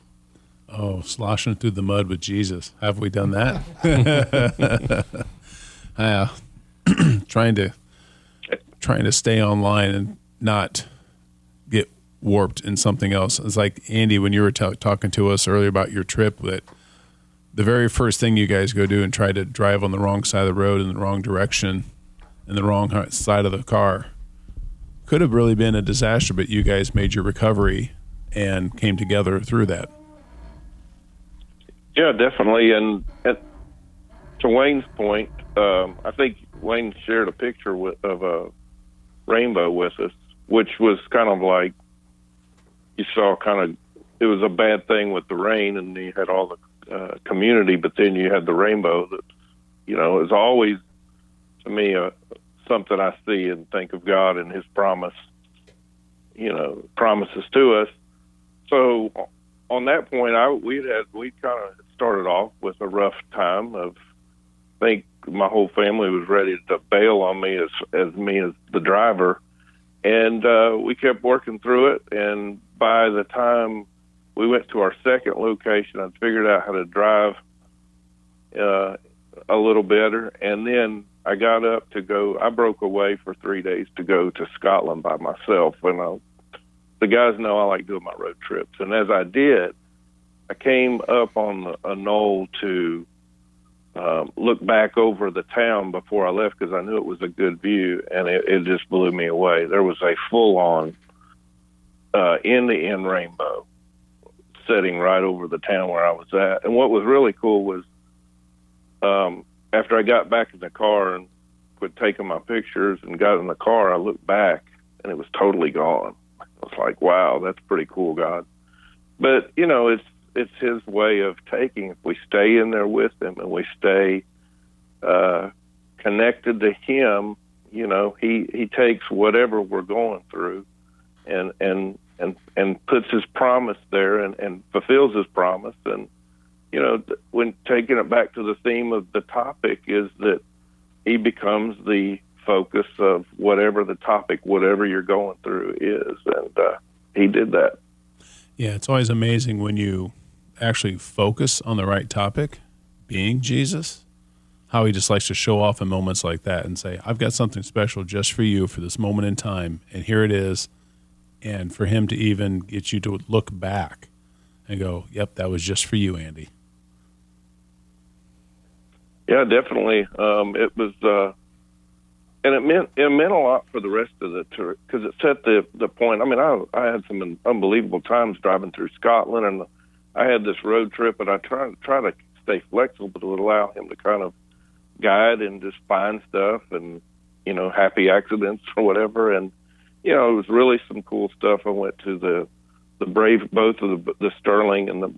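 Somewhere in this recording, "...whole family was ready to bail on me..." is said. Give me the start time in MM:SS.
01:05.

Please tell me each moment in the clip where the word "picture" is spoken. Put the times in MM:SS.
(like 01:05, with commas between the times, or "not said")
00:37, 01:52.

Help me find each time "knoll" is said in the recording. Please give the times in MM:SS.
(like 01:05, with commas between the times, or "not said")
01:31.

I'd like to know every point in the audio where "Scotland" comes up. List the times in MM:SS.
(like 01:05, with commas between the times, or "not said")
01:24, 02:58.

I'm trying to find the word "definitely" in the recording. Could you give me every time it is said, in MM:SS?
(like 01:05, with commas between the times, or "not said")
00:32, 02:49.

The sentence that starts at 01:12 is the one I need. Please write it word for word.
And by the time we went to our second location and figured out how to drive uh, a little better.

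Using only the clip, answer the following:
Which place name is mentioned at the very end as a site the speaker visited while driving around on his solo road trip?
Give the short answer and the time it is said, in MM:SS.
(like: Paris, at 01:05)
Stirling, at 03:14.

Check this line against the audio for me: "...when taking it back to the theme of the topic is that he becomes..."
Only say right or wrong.
right.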